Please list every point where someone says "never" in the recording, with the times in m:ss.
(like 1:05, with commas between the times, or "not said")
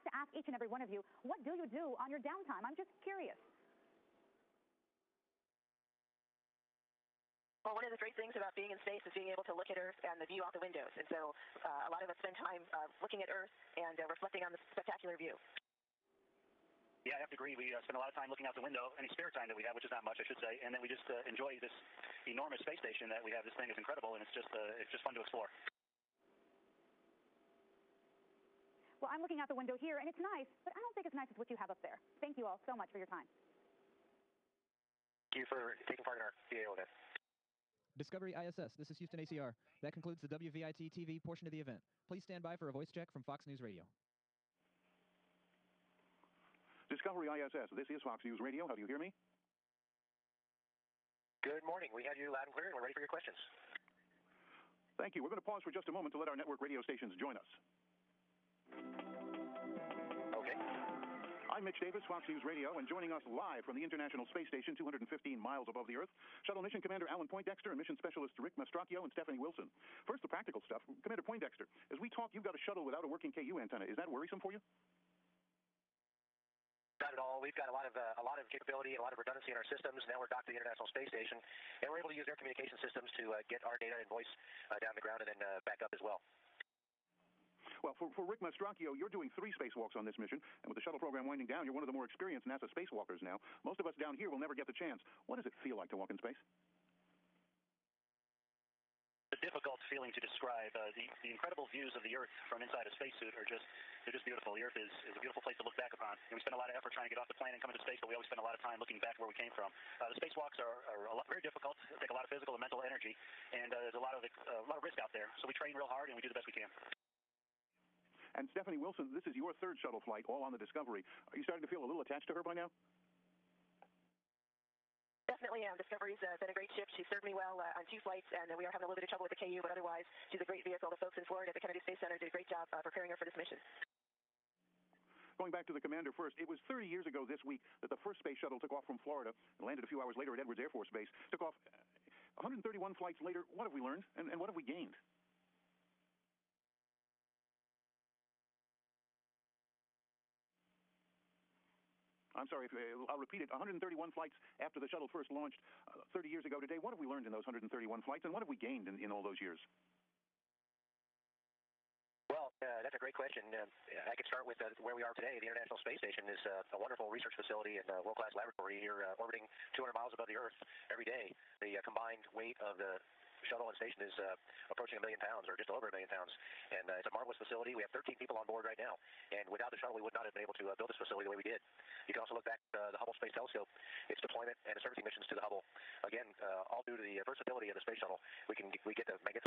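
1:34.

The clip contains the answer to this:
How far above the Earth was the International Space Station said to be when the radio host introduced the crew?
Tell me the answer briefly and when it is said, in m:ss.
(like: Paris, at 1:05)
215 miles, at 1:04.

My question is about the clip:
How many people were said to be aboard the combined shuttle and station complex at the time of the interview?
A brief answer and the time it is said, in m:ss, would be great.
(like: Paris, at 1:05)
13, at 2:57.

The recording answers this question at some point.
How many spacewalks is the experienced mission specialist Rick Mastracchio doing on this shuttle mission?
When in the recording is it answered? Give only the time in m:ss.
1:29.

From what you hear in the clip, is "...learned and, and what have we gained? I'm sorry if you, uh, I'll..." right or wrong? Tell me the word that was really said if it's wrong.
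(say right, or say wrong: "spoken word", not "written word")
right.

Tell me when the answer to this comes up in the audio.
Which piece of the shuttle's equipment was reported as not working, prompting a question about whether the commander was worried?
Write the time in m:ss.
1:13.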